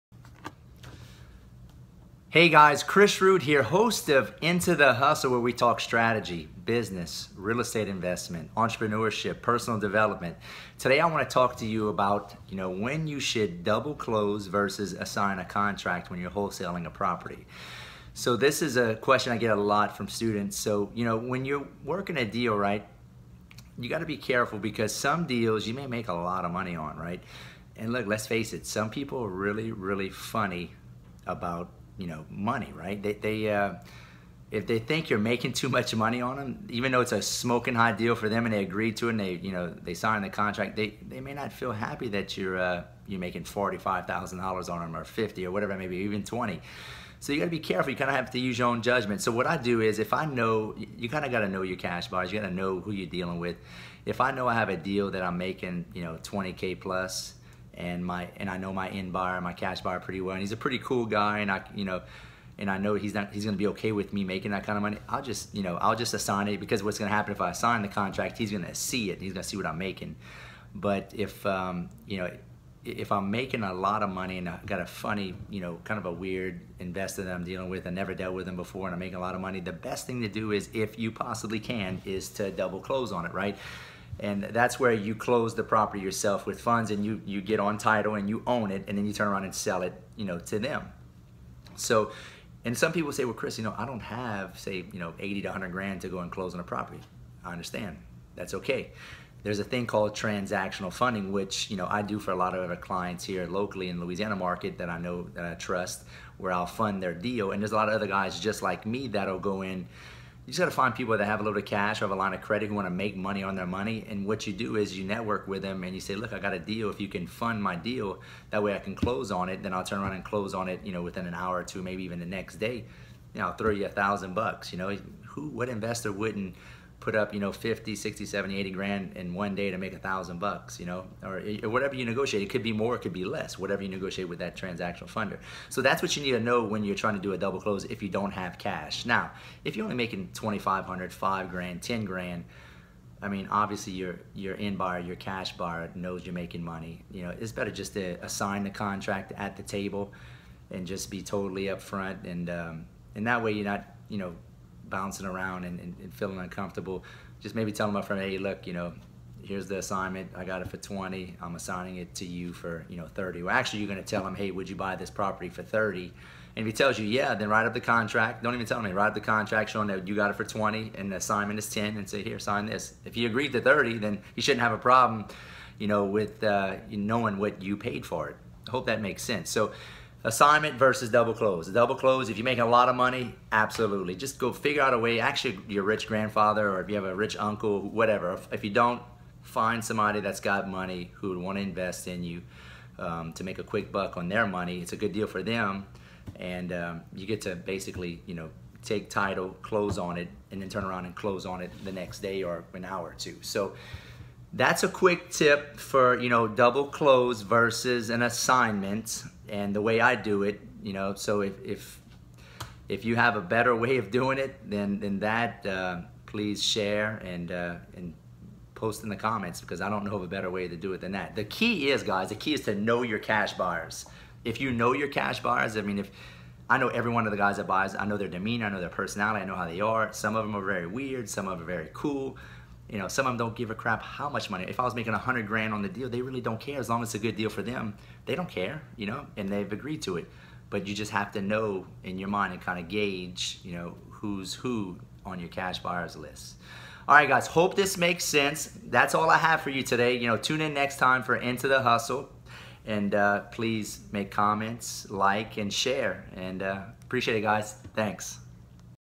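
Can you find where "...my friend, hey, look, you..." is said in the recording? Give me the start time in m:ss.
2:37.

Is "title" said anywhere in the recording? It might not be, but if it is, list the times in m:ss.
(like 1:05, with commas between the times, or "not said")
1:27, 3:19.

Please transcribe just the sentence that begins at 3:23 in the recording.
So that's a quick tip for, you know, double close versus an assignment.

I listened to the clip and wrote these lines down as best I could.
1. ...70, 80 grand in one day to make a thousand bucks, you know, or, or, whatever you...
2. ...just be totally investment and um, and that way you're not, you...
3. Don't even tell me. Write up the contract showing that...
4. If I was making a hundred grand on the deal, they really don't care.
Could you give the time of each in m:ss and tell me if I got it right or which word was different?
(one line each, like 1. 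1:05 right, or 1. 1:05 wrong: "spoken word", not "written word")
1. 2:08 right
2. 2:30 wrong: "upfront", not "investment"
3. 2:48 right
4. 3:54 right.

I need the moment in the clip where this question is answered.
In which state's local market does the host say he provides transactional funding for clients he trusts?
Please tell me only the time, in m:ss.
1:43.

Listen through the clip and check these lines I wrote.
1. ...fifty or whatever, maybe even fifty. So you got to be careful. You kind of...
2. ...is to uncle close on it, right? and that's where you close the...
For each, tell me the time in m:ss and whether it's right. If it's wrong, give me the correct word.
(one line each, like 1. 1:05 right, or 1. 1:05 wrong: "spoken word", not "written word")
1. 0:45 wrong: "twenty", not "fifty"
2. 1:22 wrong: "double", not "uncle".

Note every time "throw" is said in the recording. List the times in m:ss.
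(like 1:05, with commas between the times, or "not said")
2:03.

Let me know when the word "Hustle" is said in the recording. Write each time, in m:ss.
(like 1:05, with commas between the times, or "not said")
0:04, 4:11.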